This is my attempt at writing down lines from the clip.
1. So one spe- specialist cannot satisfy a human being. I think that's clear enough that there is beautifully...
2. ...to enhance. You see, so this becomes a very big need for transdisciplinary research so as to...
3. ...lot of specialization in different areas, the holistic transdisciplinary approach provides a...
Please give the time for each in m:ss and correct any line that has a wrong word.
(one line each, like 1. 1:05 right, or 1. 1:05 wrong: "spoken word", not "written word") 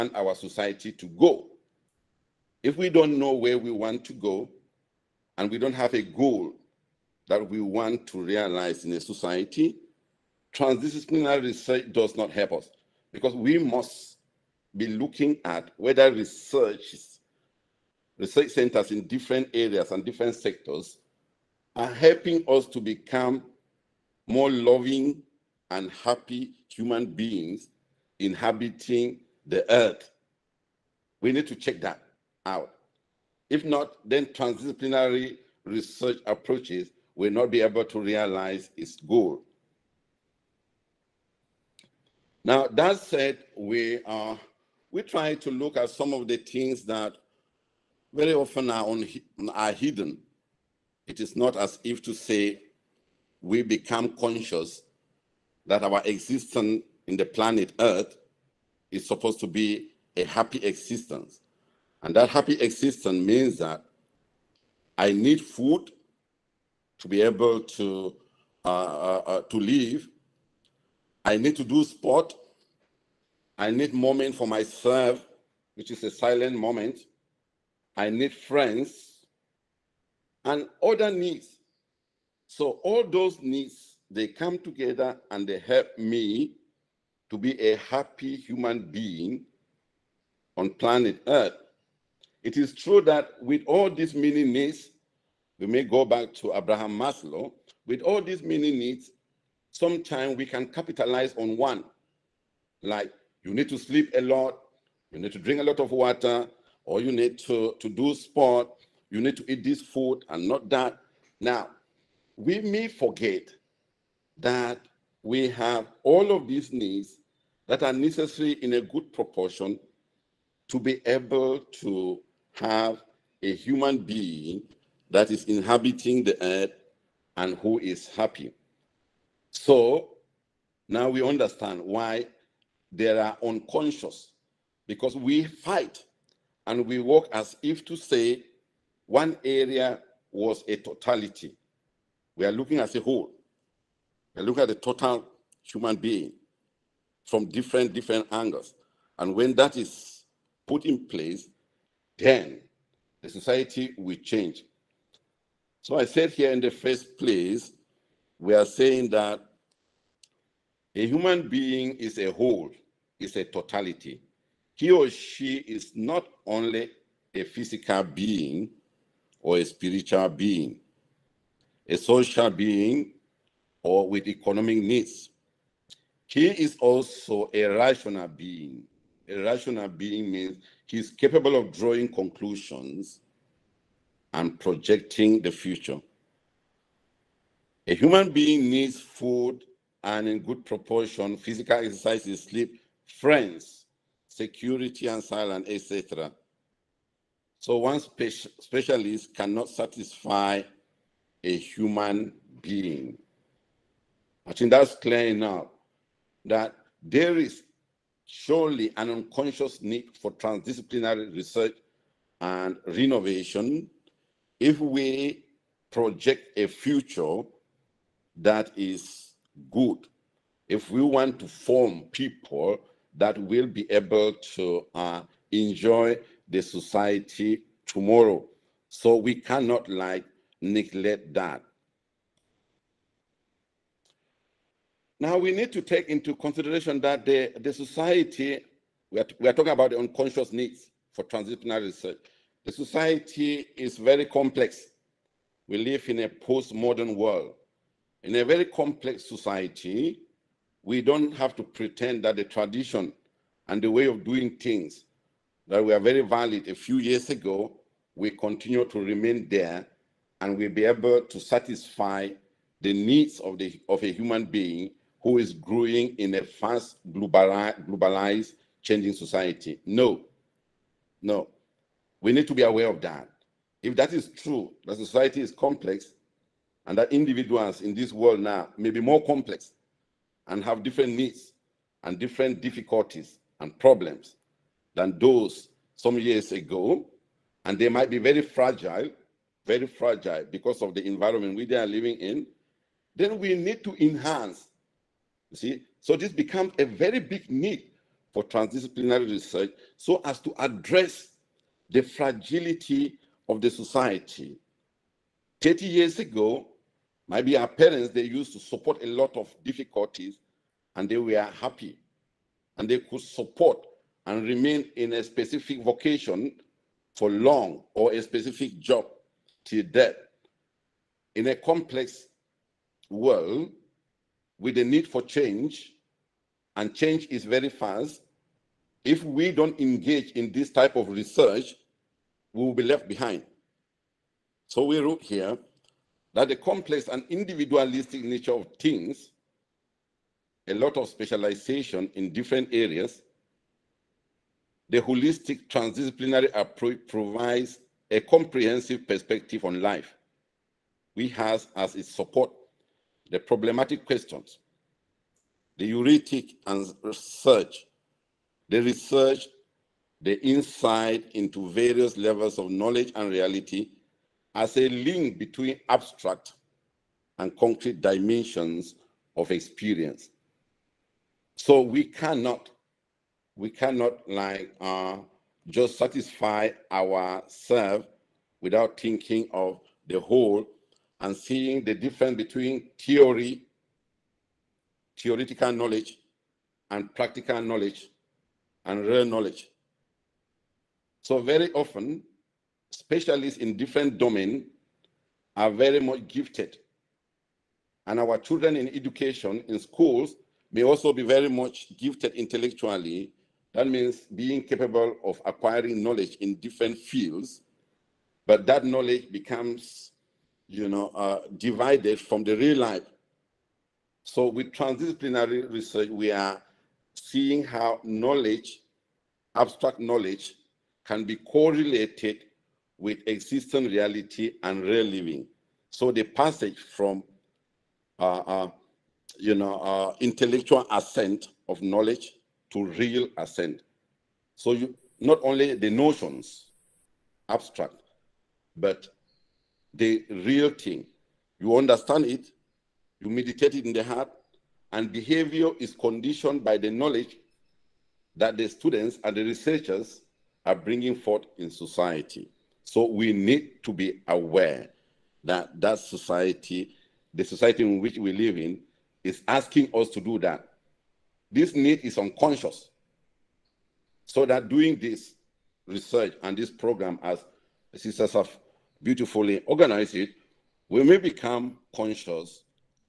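1. 3:17 wrong: "surely", not "beautifully"
2. 4:53 right
3. 5:40 right.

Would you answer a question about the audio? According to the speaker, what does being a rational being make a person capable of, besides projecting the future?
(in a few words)
drawing conclusions.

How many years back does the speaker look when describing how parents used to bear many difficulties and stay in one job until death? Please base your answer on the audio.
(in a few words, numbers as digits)
30.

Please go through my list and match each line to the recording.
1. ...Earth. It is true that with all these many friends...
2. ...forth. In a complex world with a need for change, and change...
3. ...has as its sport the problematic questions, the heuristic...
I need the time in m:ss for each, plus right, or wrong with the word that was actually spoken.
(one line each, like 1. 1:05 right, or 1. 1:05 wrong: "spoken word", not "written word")
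1. 1:31 wrong: "needs", not "friends"
2. 5:19 wrong: "death", not "forth"
3. 5:51 wrong: "support", not "sport".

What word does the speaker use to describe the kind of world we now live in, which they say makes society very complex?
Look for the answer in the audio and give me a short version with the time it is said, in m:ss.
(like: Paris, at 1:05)
postmodern, at 4:06.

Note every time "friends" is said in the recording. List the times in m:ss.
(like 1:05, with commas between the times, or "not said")
1:18, 3:13.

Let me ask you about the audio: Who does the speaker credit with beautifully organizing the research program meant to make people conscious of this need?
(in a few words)
sisters.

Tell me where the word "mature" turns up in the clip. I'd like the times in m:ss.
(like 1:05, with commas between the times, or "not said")
not said.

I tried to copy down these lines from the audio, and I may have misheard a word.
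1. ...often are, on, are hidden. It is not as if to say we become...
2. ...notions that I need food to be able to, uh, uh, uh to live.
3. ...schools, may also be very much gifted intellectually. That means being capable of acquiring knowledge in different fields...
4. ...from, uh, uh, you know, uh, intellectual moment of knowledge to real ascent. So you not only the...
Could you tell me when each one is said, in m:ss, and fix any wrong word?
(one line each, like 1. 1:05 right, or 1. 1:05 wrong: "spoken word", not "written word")
1. 0:48 right
2. 1:03 wrong: "means", not "notions"
3. 6:39 right
4. 7:06 wrong: "ascent", not "moment".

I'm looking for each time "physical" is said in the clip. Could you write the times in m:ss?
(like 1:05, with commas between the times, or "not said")
2:47, 3:11.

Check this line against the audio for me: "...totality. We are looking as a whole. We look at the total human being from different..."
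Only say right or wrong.
right.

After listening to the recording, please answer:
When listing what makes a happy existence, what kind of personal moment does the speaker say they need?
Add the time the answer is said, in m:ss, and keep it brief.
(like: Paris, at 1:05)
a silent moment, at 1:16.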